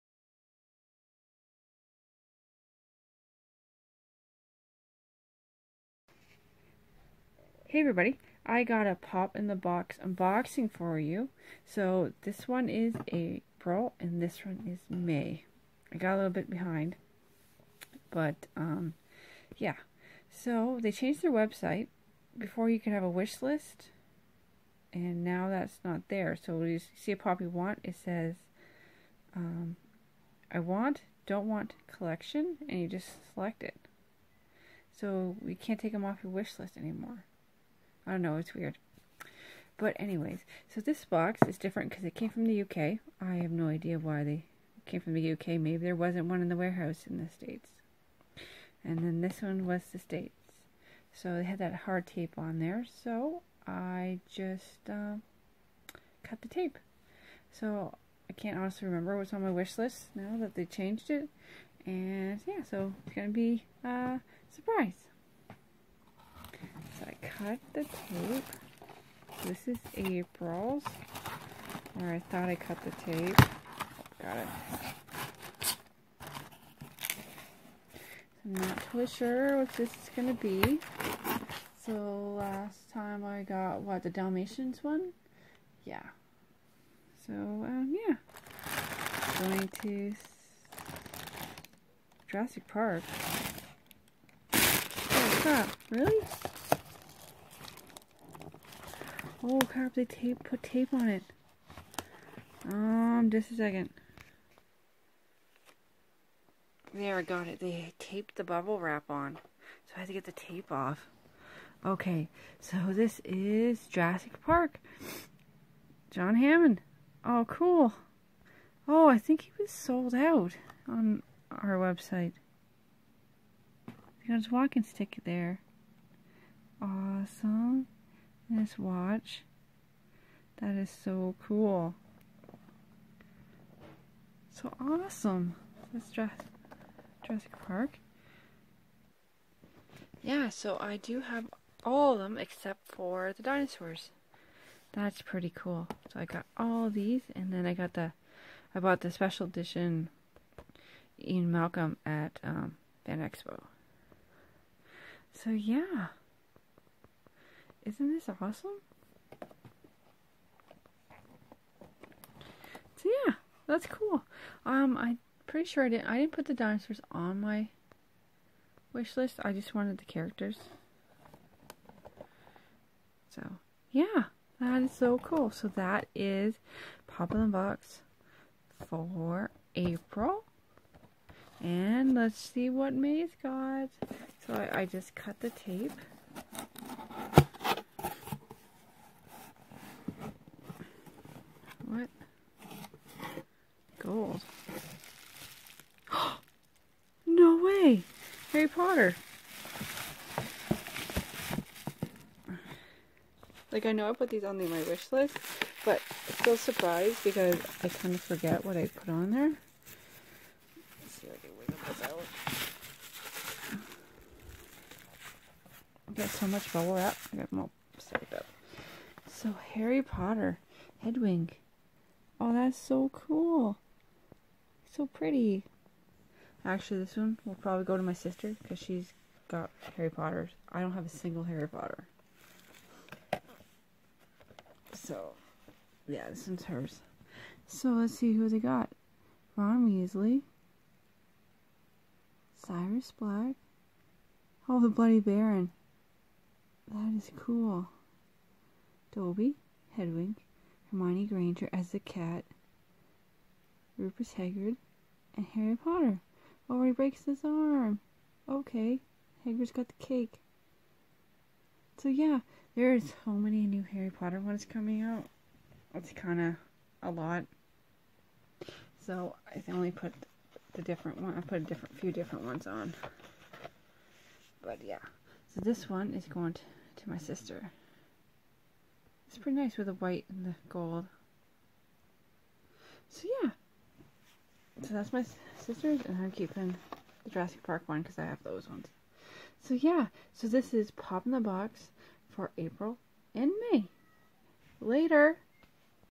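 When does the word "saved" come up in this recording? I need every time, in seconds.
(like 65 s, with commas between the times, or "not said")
217 s.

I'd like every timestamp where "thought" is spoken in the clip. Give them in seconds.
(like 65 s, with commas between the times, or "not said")
72 s.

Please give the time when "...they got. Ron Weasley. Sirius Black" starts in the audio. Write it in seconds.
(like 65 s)
238 s.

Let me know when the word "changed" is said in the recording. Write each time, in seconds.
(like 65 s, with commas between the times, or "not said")
20 s, 60 s.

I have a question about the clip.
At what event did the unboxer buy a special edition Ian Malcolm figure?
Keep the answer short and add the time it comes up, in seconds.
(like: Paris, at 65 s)
Fan Expo, at 153 s.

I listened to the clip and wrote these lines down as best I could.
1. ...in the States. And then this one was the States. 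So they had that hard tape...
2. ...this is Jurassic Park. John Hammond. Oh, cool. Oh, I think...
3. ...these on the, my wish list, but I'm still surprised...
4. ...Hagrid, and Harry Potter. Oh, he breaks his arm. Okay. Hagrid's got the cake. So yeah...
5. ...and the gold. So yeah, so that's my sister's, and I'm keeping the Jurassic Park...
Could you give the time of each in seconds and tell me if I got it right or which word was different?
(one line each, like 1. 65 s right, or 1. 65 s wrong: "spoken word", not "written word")
1. 47 s right
2. 112 s right
3. 204 s right
4. 254 s right
5. 280 s right.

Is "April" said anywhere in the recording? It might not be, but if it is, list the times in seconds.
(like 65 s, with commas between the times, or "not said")
13 s, 69 s, 179 s, 292 s.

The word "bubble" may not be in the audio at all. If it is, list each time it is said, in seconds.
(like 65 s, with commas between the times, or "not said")
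108 s, 216 s.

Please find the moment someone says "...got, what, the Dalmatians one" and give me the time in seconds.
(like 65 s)
83 s.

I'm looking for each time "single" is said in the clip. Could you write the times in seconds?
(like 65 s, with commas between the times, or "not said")
231 s.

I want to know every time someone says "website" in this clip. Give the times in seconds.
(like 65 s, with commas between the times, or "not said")
21 s, 121 s.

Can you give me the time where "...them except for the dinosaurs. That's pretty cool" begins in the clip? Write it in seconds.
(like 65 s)
142 s.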